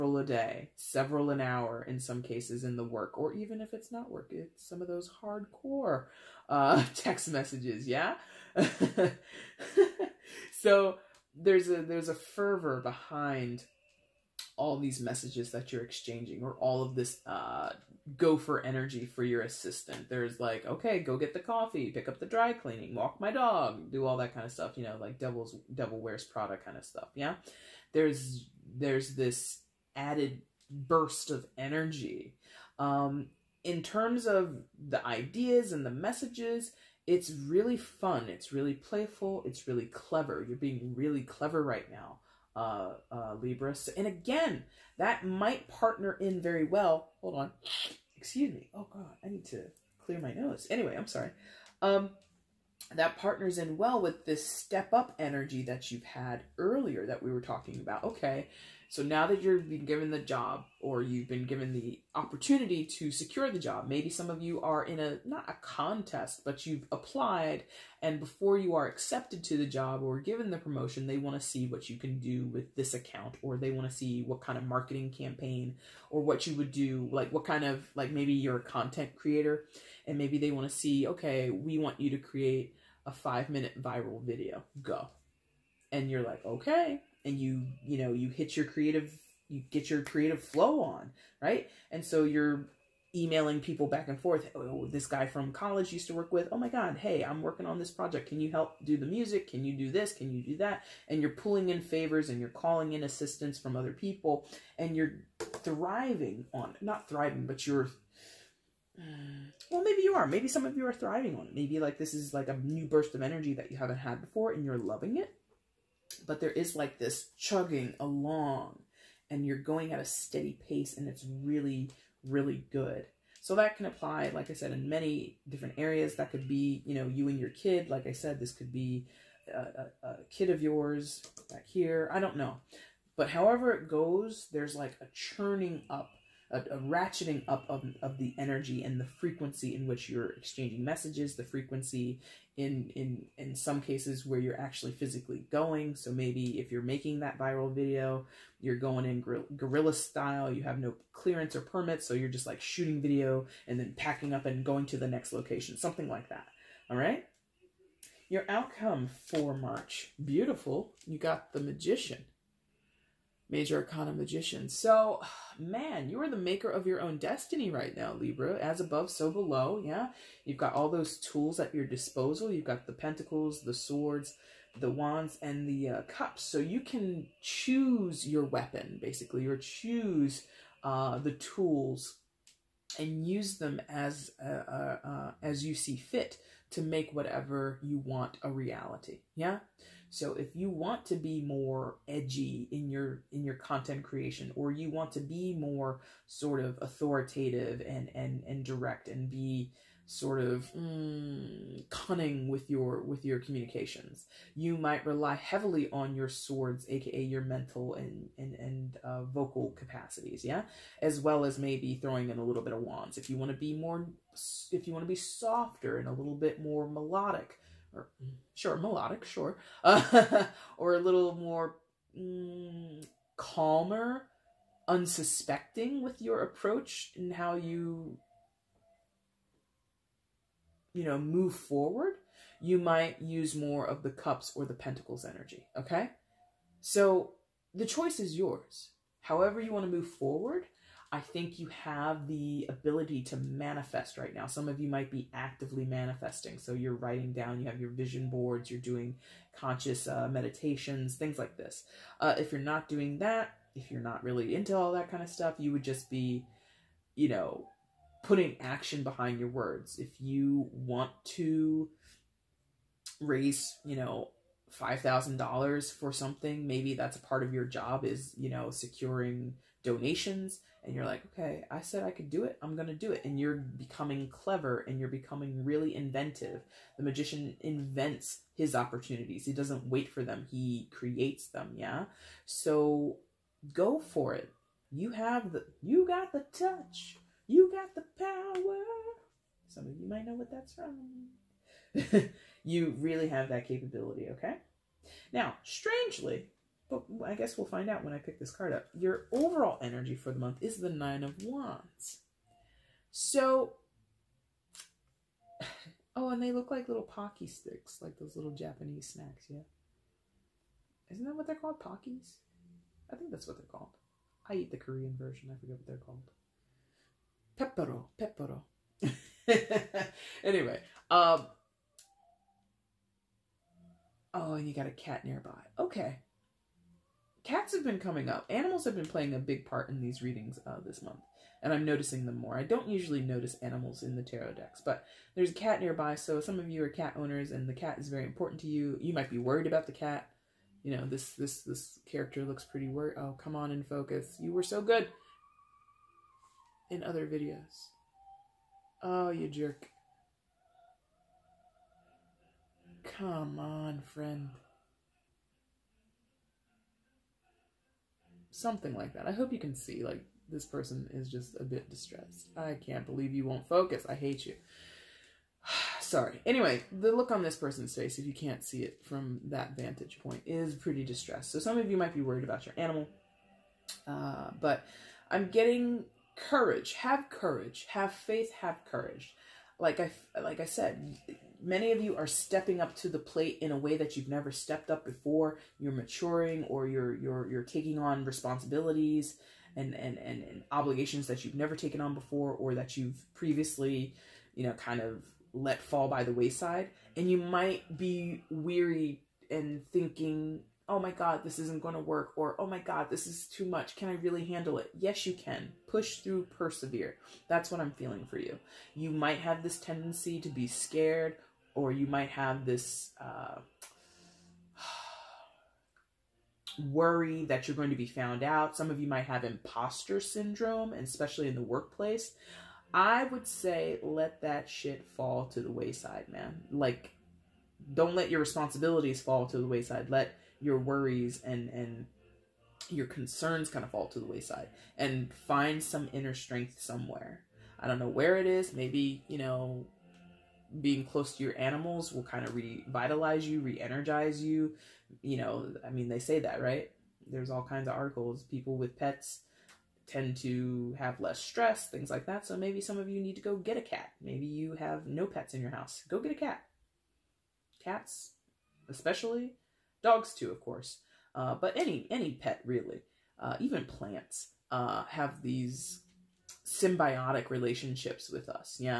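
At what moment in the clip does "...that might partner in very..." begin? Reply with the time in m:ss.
0:44.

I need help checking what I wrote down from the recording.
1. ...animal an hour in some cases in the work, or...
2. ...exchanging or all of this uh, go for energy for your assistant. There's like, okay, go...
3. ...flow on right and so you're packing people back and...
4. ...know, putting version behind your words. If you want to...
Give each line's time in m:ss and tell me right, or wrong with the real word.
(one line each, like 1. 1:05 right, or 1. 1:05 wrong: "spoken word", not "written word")
1. 0:00 wrong: "several", not "animal"
2. 0:15 right
3. 1:30 wrong: "emailing", not "packing"
4. 4:17 wrong: "action", not "version".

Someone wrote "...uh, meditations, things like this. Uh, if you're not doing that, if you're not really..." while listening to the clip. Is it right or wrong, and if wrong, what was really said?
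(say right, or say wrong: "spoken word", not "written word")
right.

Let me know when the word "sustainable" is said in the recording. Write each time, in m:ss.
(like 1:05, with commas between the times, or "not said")
not said.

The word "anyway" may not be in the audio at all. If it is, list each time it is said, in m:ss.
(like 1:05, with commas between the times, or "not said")
0:50, 5:20, 6:06.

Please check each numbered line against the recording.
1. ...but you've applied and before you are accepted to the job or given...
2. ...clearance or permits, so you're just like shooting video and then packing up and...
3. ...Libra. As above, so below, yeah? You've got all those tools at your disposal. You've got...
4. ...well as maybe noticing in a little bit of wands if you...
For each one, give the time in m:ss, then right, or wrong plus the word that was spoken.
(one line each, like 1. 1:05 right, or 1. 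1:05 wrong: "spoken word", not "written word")
1. 1:06 right
2. 2:31 right
3. 2:48 right
4. 3:31 wrong: "throwing", not "noticing".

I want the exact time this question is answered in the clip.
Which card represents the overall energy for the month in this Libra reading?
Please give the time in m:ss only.
5:00.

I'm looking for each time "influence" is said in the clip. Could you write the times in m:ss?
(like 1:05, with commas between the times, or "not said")
not said.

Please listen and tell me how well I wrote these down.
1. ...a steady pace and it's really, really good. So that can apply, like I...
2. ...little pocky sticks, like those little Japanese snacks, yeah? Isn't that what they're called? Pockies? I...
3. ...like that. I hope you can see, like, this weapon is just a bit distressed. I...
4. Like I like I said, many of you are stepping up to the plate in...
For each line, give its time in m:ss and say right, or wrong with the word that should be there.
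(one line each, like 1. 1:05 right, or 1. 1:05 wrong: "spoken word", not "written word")
1. 1:59 right
2. 5:06 right
3. 5:58 wrong: "person", not "weapon"
4. 6:19 right.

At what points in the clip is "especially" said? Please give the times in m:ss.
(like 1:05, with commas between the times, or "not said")
7:00, 7:38.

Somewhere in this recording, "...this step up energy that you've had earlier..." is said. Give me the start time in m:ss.
0:54.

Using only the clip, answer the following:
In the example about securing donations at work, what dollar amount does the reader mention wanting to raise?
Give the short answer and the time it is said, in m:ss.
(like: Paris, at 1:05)
$5,000, at 4:24.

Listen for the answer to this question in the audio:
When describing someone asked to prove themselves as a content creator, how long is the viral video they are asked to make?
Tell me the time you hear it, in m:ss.
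1:23.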